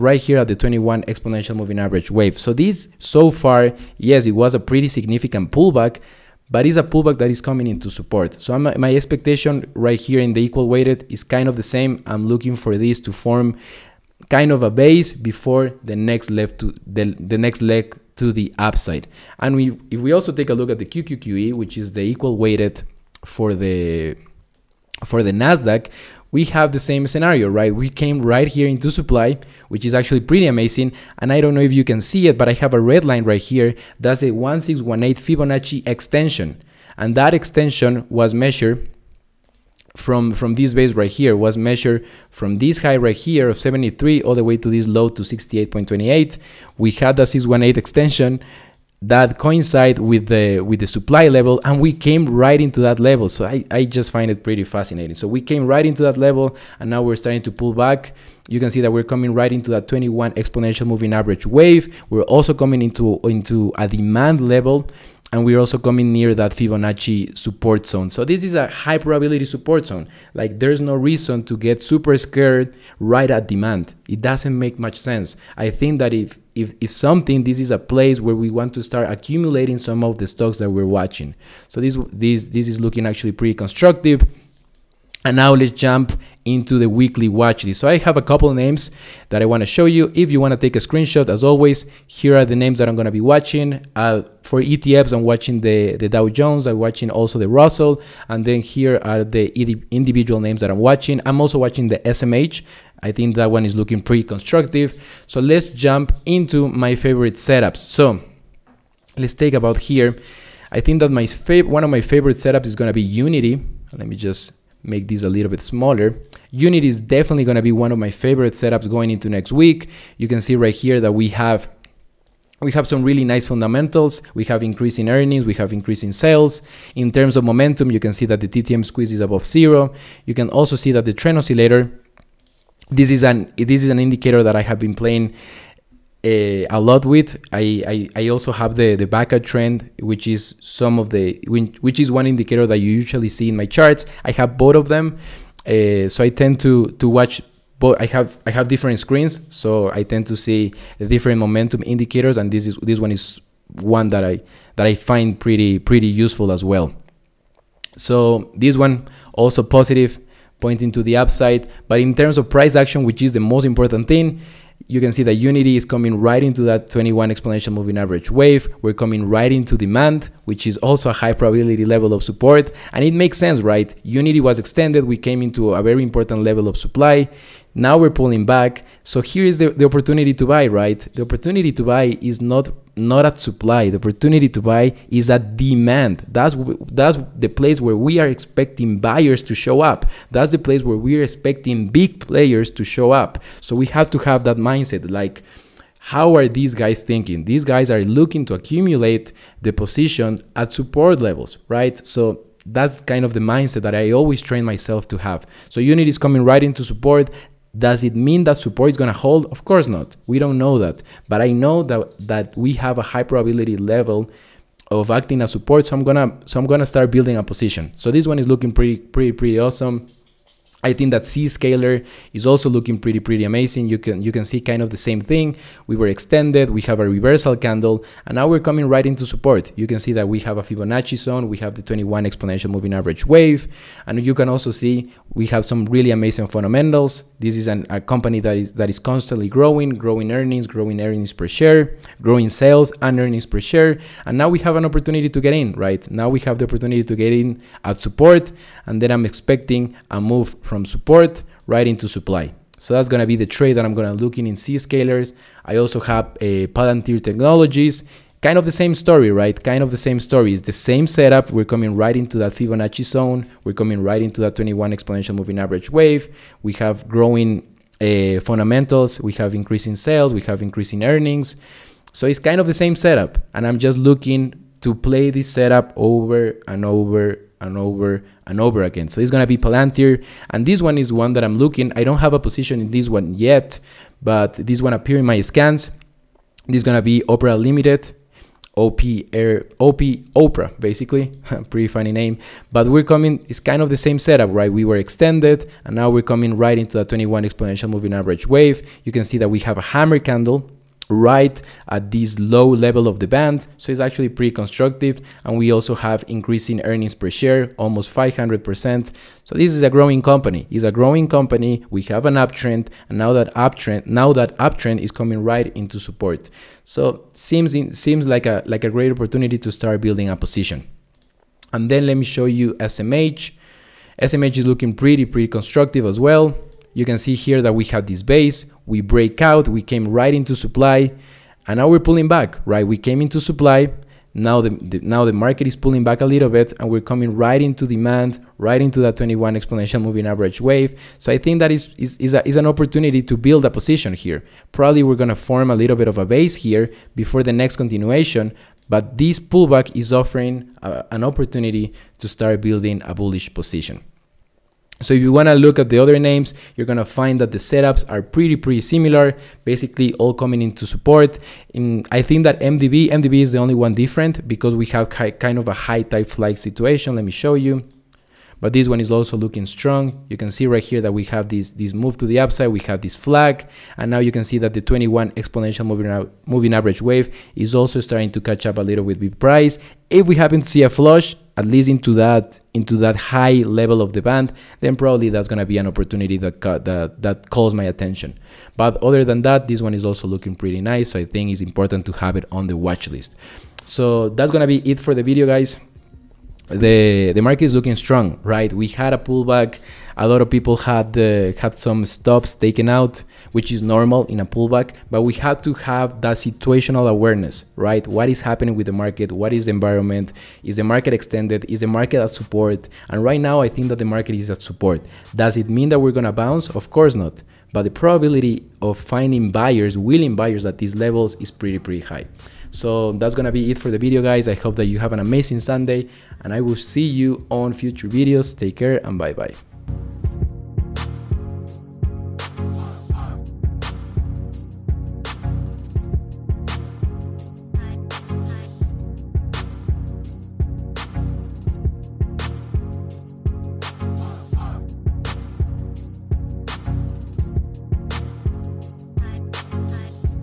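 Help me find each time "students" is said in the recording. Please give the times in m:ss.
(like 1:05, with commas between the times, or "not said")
not said.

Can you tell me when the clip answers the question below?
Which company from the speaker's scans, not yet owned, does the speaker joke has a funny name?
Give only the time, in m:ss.
4:47.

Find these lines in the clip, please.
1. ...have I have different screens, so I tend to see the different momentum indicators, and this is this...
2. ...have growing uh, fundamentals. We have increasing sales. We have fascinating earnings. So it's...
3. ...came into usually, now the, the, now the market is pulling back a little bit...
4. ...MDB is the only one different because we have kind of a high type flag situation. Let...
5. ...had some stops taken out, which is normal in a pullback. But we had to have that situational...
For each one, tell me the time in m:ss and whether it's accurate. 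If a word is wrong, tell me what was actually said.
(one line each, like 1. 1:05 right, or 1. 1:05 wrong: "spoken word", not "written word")
1. 2:28 right
2. 4:26 wrong: "increasing", not "fascinating"
3. 5:32 wrong: "supply", not "usually"
4. 6:03 right
5. 6:41 right.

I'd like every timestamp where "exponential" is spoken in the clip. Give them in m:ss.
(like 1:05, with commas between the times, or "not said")
0:01, 1:00, 2:47, 3:52, 4:24, 4:57, 5:39, 6:15.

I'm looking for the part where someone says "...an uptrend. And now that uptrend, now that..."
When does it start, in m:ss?
5:12.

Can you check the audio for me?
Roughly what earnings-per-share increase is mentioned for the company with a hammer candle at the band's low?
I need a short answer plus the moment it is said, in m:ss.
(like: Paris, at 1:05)
500%, at 5:08.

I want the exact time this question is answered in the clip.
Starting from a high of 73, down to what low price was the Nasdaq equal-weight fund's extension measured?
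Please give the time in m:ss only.
0:45.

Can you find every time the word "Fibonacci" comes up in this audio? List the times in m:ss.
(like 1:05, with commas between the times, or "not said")
0:35, 1:06, 3:50, 4:22.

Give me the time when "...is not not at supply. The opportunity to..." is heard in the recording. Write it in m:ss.
3:02.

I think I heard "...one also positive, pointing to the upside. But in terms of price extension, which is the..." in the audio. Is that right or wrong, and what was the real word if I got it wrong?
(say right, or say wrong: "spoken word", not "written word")
wrong: "action", not "extension".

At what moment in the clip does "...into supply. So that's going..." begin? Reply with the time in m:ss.
4:11.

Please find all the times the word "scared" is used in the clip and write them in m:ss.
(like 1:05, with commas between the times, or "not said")
1:12.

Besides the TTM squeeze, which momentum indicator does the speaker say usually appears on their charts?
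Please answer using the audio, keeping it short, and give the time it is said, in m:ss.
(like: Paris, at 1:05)
Baca trend, at 2:19.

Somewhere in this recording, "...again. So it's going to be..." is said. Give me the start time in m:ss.
4:38.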